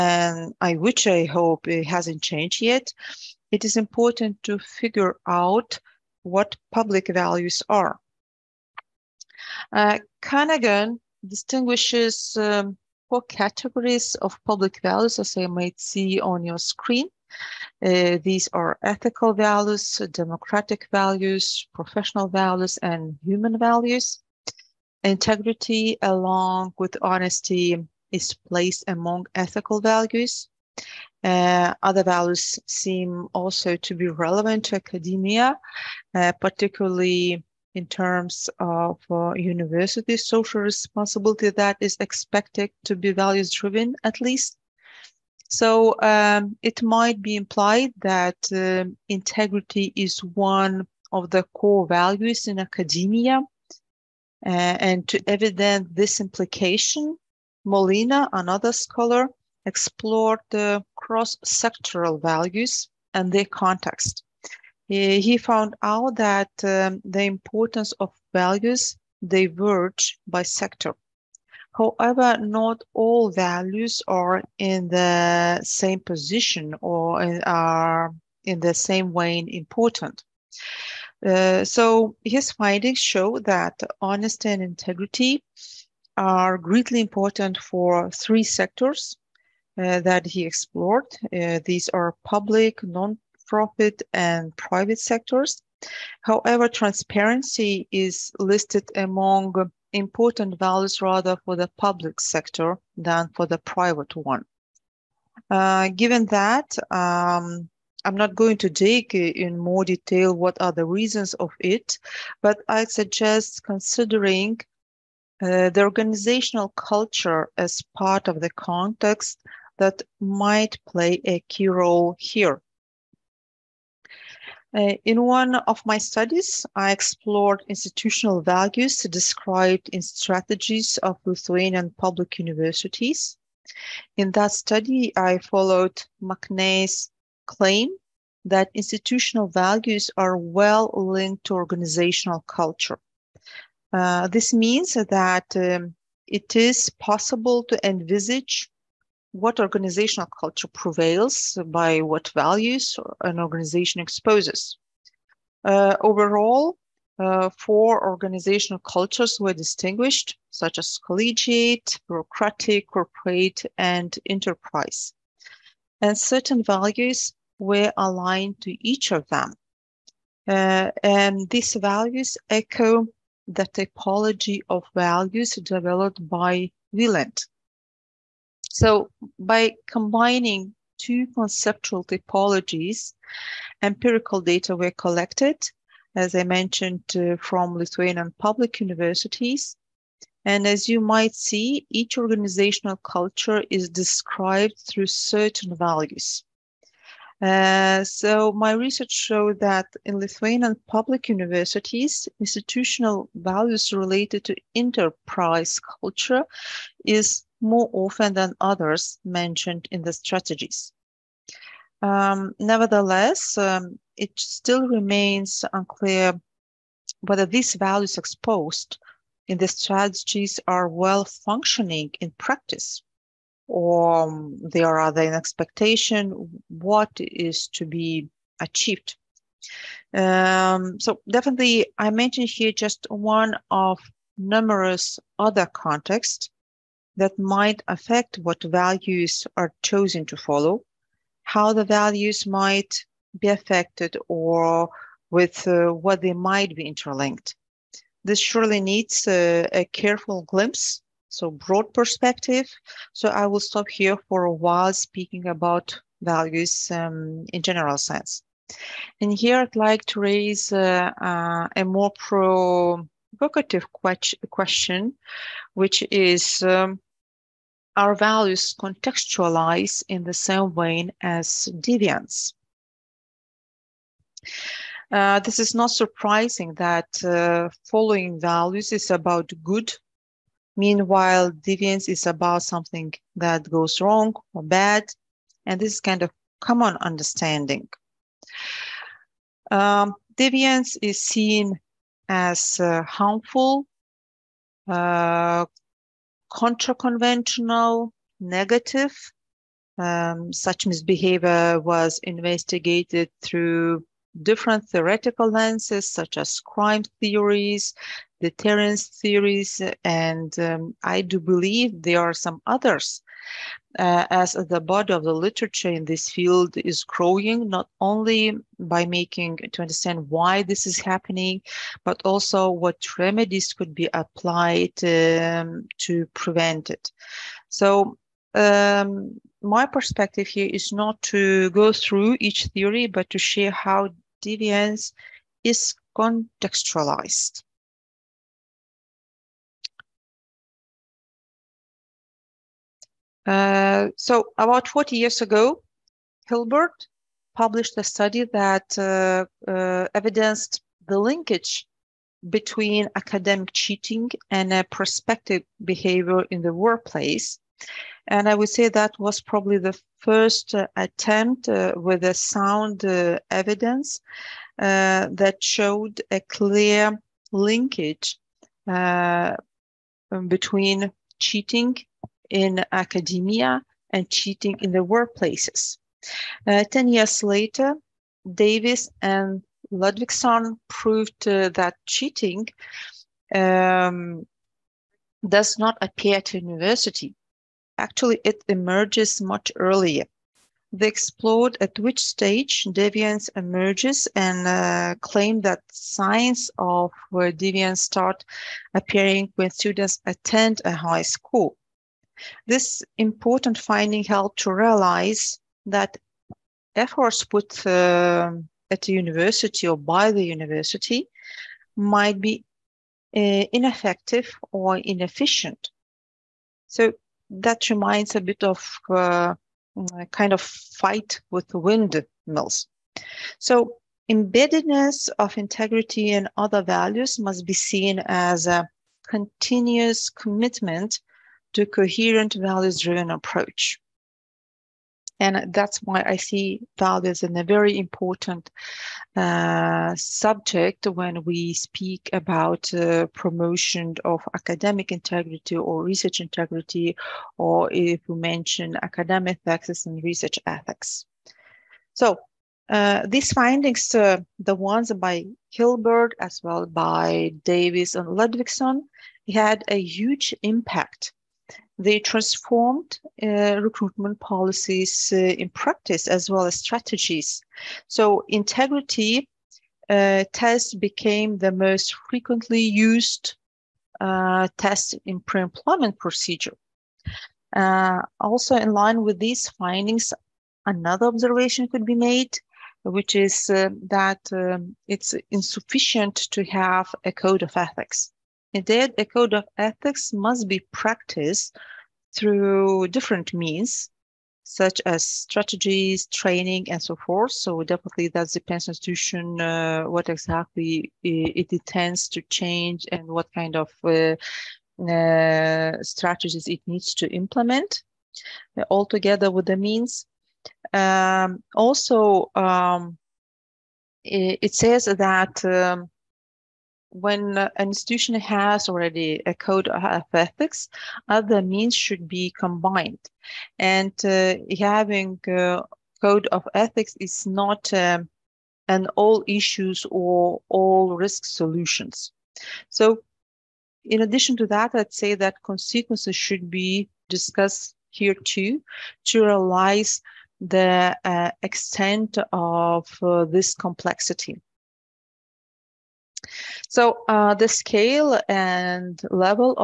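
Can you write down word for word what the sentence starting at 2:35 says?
Uh, overall, uh, four organizational cultures were distinguished, such as collegiate, bureaucratic, corporate, and enterprise.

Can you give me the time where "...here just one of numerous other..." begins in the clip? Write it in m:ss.
3:52.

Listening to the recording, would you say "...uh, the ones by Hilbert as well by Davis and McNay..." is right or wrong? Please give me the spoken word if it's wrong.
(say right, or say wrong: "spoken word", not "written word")
wrong: "Ludvigson", not "McNay".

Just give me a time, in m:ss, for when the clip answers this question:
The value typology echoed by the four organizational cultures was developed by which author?
2:56.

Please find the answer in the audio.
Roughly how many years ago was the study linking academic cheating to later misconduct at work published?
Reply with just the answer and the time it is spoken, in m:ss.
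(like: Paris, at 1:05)
40, at 5:44.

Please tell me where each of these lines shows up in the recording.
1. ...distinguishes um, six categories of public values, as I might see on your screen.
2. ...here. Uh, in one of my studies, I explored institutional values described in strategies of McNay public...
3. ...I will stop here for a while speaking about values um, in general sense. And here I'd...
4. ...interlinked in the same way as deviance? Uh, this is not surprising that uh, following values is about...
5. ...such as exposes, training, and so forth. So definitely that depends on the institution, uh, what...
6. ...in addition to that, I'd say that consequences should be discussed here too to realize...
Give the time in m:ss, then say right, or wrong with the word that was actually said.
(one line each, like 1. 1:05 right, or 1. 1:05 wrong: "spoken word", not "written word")
1. 0:11 wrong: "four", not "six"
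2. 2:02 wrong: "Lithuanian", not "McNay"
3. 4:13 right
4. 4:28 wrong: "contextualized", not "interlinked"
5. 8:14 wrong: "strategies", not "exposes"
6. 8:54 right.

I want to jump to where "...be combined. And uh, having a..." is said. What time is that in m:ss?
8:42.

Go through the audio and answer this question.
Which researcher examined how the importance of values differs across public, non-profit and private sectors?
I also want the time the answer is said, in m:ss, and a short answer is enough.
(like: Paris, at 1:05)
Molina, at 0:57.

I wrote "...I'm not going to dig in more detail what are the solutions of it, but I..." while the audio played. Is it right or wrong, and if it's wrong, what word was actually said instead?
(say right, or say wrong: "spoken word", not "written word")
wrong: "reasons", not "solutions".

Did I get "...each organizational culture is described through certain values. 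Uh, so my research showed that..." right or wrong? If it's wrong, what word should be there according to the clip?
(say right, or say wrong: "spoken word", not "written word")
right.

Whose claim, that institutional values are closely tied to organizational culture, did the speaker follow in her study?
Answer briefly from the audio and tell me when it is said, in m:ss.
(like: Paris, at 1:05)
McNay, at 2:16.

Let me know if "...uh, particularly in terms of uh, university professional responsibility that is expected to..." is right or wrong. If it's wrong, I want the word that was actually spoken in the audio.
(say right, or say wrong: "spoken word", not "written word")
wrong: "social", not "professional".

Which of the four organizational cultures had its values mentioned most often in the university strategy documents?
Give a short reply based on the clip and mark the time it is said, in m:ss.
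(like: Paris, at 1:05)
Enterprise culture, at 3:24.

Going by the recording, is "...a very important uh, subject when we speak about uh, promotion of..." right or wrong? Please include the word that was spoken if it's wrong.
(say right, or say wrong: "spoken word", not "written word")
right.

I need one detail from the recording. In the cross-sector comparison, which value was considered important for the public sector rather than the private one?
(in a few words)
Transparency.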